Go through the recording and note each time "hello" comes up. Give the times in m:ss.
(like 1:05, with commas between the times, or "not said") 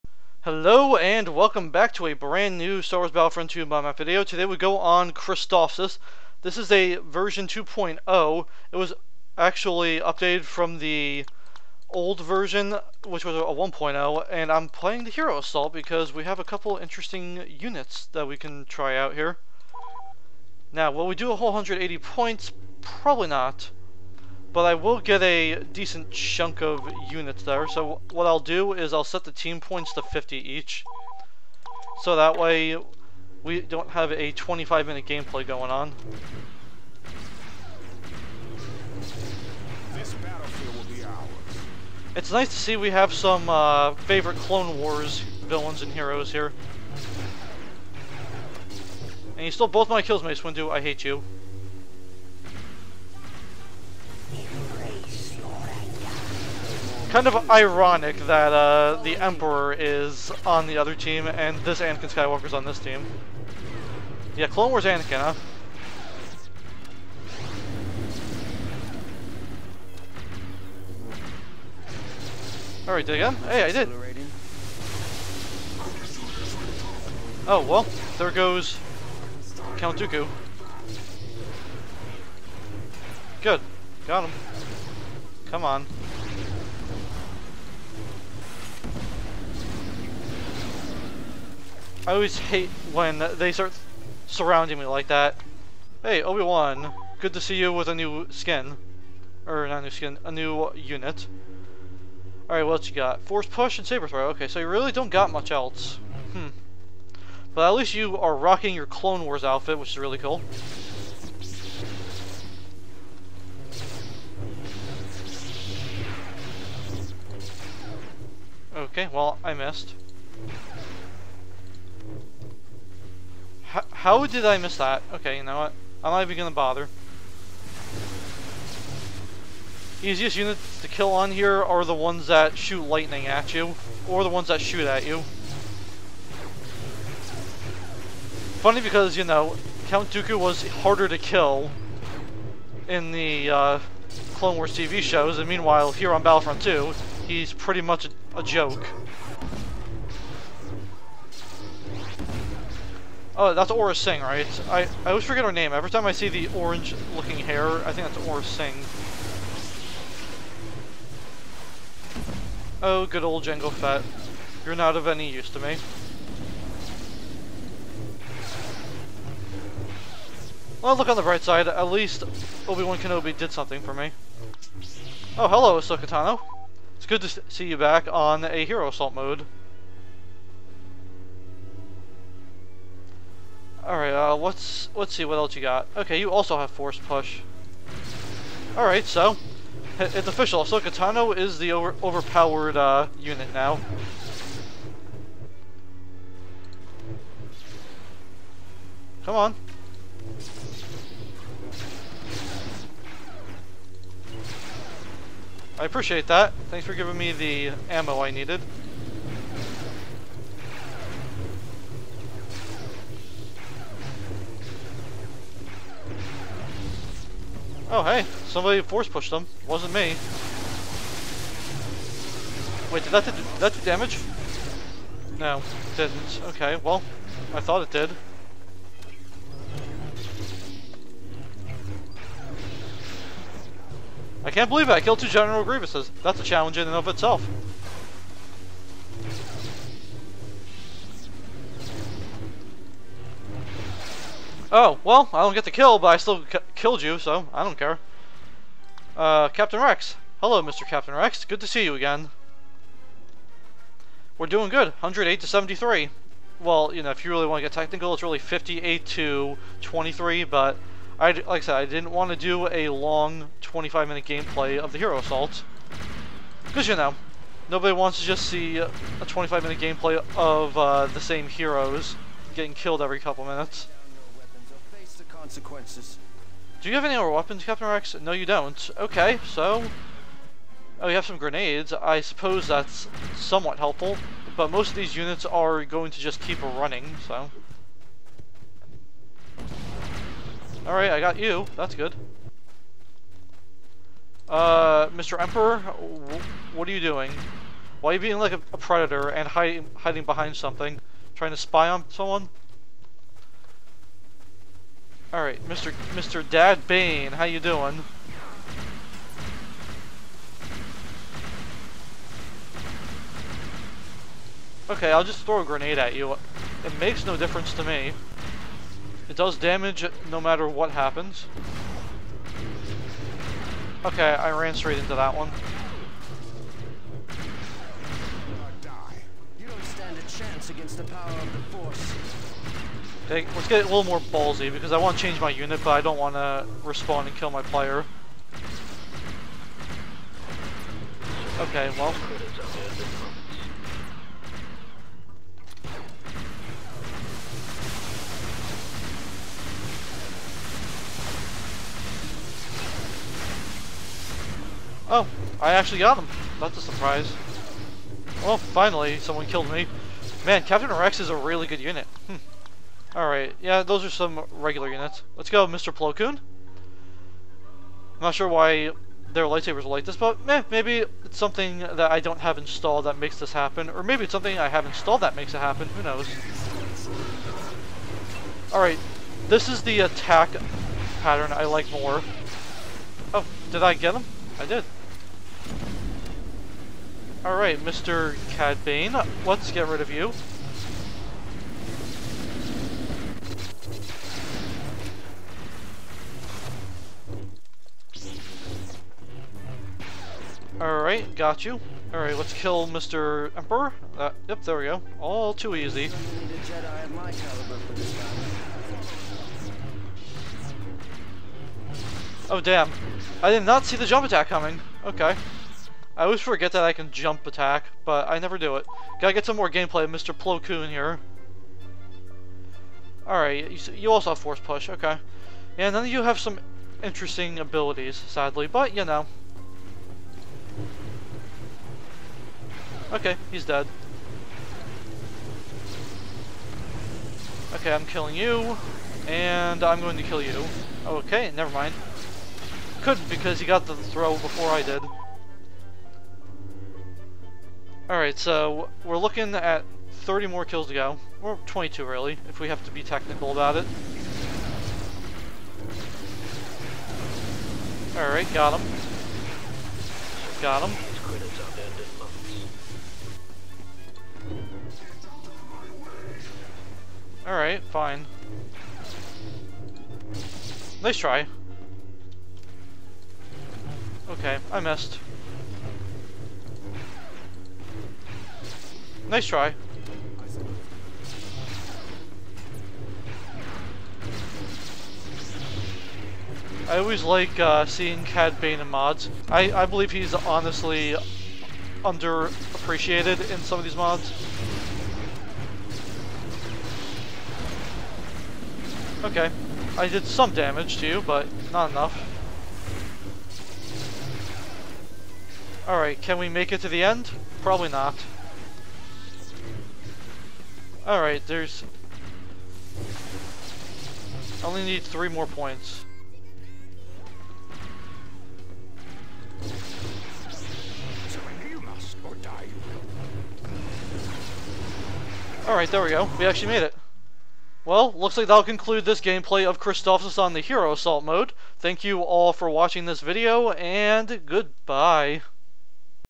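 0:00, 2:55, 4:10.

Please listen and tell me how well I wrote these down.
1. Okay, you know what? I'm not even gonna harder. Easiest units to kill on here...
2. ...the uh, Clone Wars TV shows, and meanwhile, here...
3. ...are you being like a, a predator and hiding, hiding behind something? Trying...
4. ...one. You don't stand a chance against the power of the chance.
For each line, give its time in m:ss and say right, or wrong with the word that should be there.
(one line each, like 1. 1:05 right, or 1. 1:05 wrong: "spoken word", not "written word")
1. 2:05 wrong: "bother", not "harder"
2. 2:23 right
3. 4:58 right
4. 5:25 wrong: "force", not "chance".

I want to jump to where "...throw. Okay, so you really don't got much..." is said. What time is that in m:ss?
1:44.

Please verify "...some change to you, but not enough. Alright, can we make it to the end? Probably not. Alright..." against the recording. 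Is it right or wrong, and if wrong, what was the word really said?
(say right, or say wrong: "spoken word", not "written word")
wrong: "damage", not "change".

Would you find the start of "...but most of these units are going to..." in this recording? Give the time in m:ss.
4:44.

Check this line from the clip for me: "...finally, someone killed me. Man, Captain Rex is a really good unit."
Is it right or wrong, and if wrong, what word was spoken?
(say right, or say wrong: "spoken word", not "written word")
right.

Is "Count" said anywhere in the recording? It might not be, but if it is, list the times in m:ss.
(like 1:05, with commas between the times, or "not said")
1:19, 2:19.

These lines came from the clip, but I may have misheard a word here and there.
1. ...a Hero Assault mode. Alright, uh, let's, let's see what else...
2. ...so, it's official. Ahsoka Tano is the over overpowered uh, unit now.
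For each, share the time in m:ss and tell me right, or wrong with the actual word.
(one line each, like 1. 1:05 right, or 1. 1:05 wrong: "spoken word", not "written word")
1. 2:58 right
2. 3:09 right.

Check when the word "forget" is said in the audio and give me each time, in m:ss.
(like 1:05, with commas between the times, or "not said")
2:35, 6:56.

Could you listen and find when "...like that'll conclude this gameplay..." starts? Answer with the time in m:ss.
8:48.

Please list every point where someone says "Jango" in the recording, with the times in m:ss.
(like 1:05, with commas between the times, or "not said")
2:43.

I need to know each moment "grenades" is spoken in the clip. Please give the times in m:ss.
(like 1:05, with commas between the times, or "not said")
4:41, 5:15.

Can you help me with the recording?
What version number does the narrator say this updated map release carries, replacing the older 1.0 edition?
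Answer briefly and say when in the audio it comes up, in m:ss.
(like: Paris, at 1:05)
2.0, at 0:07.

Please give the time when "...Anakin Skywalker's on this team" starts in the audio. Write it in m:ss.
1:01.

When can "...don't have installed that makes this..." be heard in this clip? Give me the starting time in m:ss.
6:12.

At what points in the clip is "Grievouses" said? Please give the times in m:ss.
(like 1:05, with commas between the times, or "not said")
3:55.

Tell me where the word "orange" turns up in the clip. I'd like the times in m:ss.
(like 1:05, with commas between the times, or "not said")
2:36.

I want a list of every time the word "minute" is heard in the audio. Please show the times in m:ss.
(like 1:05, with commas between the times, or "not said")
0:34, 4:23, 4:29, 4:33.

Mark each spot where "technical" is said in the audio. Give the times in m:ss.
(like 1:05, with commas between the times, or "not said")
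4:17, 7:33.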